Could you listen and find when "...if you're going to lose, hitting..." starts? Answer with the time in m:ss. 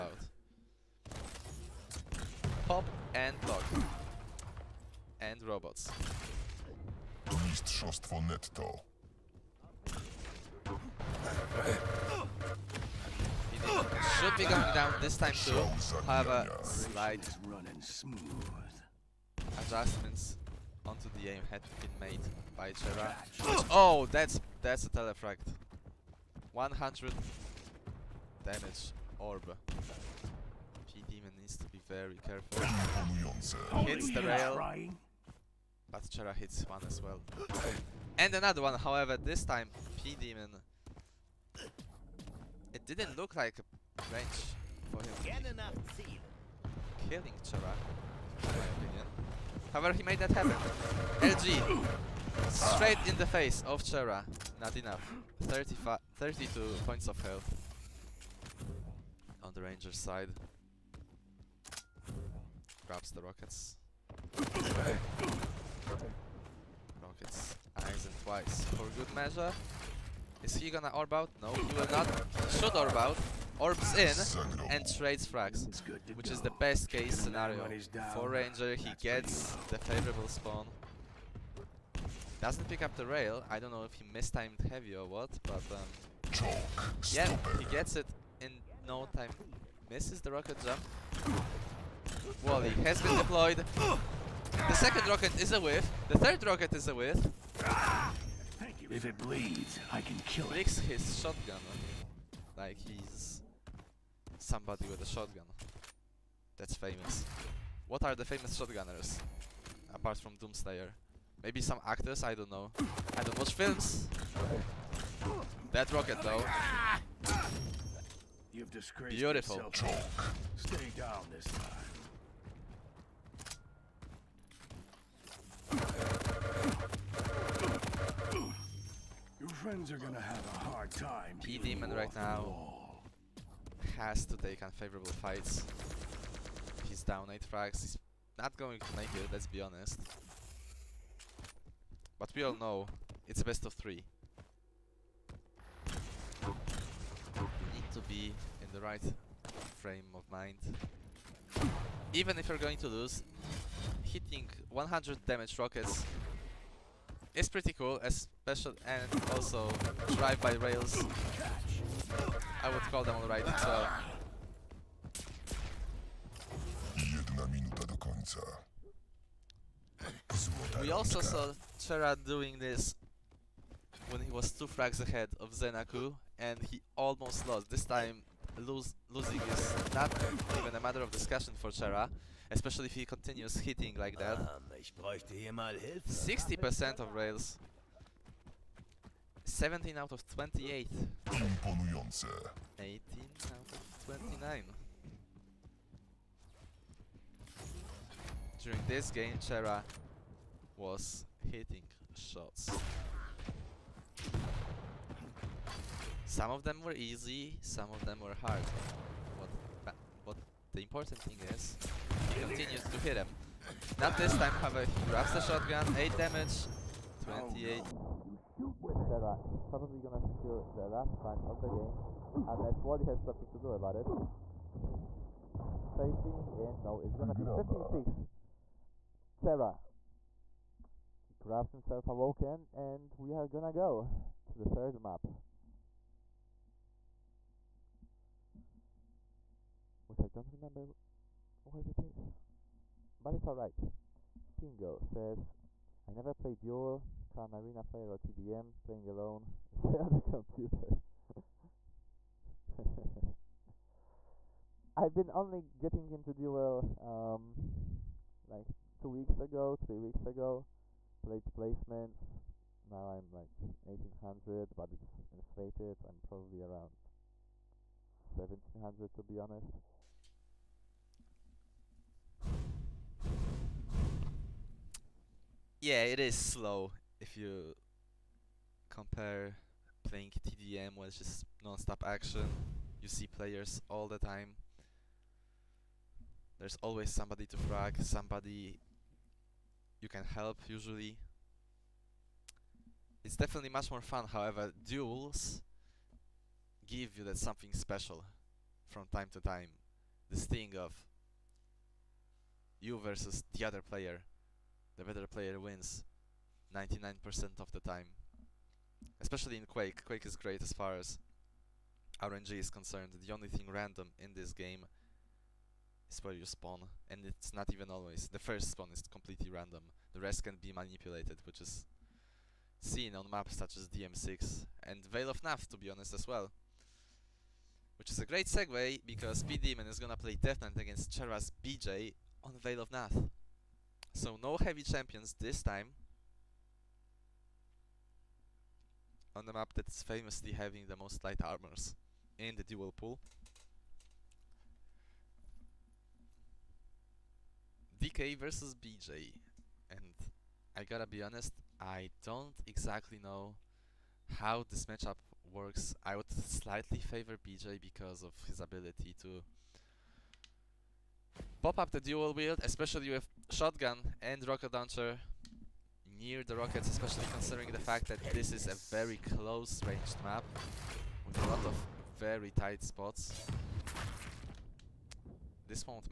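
2:32.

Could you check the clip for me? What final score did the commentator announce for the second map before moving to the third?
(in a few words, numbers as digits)
15-6.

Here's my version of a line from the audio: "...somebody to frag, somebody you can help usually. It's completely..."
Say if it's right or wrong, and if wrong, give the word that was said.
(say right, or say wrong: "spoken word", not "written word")
wrong: "definitely", not "completely".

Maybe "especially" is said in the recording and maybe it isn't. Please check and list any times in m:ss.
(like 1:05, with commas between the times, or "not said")
2:38, 3:02, 5:09, 6:02, 6:06.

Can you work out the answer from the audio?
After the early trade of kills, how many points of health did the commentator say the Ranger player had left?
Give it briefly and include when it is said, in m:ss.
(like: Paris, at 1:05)
32, at 0:55.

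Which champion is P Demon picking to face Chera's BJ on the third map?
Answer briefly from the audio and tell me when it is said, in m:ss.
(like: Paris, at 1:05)
Death Knight, at 5:30.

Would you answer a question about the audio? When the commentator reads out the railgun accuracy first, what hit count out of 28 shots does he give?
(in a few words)
17.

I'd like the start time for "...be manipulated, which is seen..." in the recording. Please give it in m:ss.
5:20.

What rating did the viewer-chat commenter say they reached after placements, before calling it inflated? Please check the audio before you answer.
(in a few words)
1800.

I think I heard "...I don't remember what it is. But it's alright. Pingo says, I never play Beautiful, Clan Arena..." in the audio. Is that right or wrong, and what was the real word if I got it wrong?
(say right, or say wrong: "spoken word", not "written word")
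wrong: "Duel", not "Beautiful".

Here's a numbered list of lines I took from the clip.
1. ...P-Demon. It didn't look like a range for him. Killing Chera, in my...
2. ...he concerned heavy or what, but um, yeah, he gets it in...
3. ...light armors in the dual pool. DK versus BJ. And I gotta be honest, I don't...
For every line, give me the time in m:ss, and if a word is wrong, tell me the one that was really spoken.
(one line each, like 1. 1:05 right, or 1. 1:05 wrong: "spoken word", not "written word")
1. 0:40 right
2. 1:23 wrong: "mistimed", not "concerned"
3. 5:41 right.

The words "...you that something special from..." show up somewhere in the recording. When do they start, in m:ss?
4:57.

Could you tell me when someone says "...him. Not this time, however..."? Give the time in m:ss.
3:33.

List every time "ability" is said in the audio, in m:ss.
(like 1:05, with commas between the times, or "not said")
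5:58.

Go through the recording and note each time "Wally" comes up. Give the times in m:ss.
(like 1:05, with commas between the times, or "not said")
1:32, 3:42.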